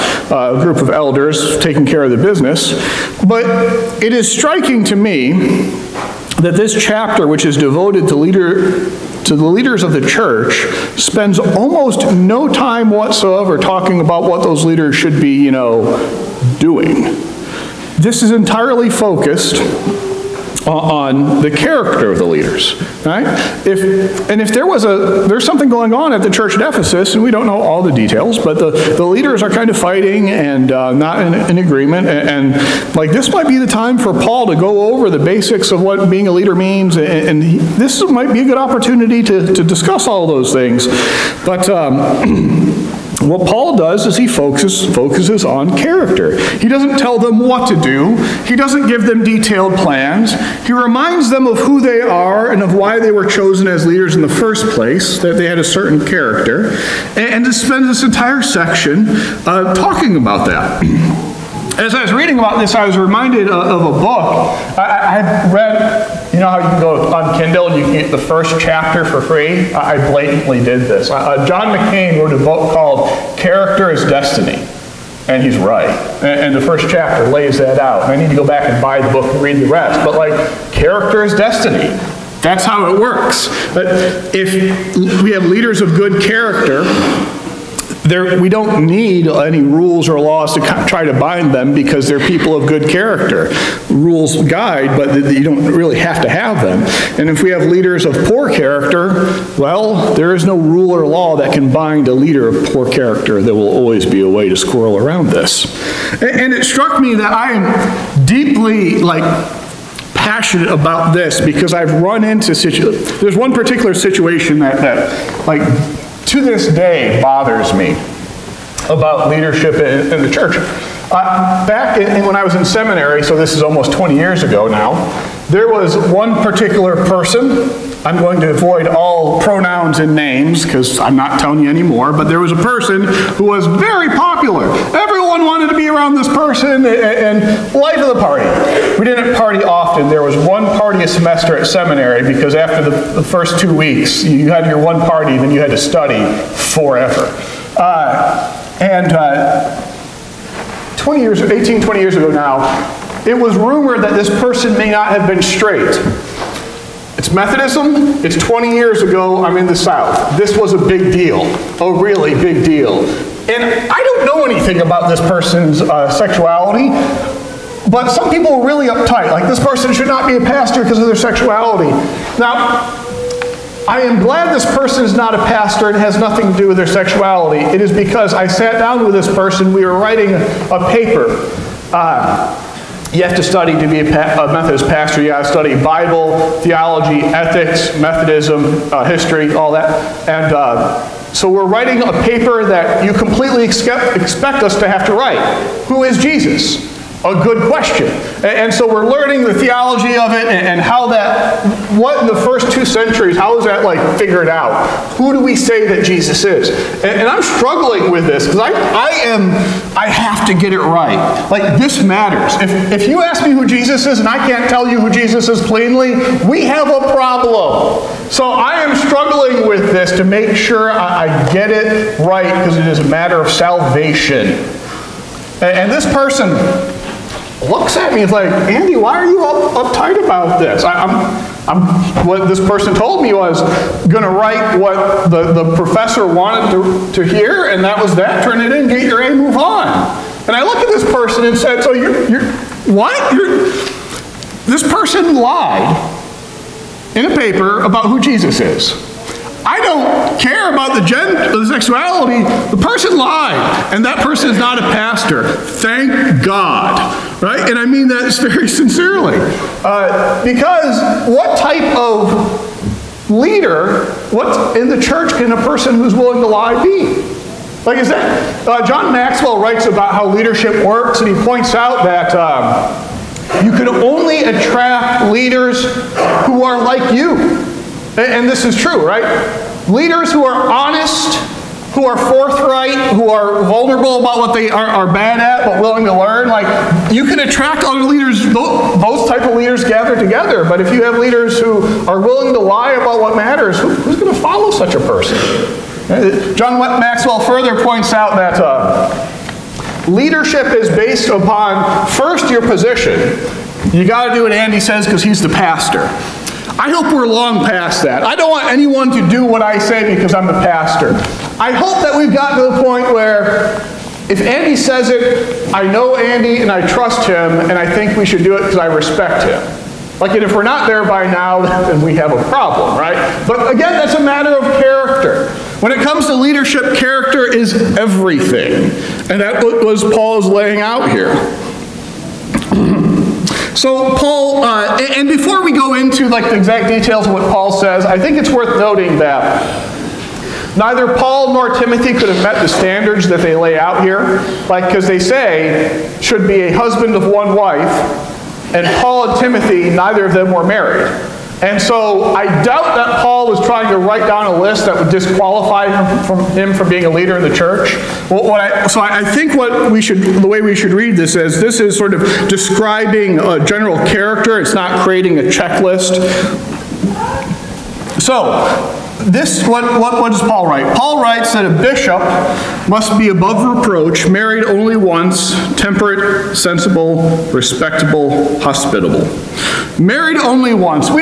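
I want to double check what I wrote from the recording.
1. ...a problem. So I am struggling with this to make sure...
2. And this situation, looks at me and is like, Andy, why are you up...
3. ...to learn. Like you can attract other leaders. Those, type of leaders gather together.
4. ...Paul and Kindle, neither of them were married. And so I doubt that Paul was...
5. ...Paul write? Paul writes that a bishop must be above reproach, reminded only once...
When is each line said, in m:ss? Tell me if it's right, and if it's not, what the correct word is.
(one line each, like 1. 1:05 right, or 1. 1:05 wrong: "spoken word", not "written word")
1. 3:36 right
2. 3:45 wrong: "person", not "situation"
3. 4:46 right
4. 5:49 wrong: "Timothy", not "Kindle"
5. 6:10 wrong: "married", not "reminded".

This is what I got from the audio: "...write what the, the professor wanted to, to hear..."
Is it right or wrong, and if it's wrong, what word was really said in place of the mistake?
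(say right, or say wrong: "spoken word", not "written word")
right.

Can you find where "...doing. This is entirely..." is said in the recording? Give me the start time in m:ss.
0:16.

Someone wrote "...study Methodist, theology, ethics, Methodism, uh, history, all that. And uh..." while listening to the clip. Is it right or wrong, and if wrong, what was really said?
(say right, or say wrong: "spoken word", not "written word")
wrong: "Bible", not "Methodist".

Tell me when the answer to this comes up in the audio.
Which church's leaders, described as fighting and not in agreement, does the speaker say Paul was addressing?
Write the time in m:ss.
0:26.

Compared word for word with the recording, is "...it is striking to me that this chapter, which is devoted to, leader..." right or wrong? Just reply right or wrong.
right.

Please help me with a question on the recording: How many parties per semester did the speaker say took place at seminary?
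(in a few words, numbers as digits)
1.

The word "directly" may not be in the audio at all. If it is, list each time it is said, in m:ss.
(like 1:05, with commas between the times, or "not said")
not said.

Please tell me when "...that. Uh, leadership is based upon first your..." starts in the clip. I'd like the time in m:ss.
4:58.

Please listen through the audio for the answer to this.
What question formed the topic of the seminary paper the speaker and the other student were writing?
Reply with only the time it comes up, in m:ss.
3:15.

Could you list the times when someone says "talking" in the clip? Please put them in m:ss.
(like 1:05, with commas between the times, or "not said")
0:13, 0:59.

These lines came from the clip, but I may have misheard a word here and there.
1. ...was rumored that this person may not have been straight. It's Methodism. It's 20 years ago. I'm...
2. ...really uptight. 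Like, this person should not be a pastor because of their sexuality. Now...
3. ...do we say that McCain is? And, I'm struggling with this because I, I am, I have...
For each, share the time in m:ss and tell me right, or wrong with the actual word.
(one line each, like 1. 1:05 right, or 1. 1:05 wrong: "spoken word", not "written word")
1. 2:33 right
2. 2:48 right
3. 3:25 wrong: "Jesus", not "McCain".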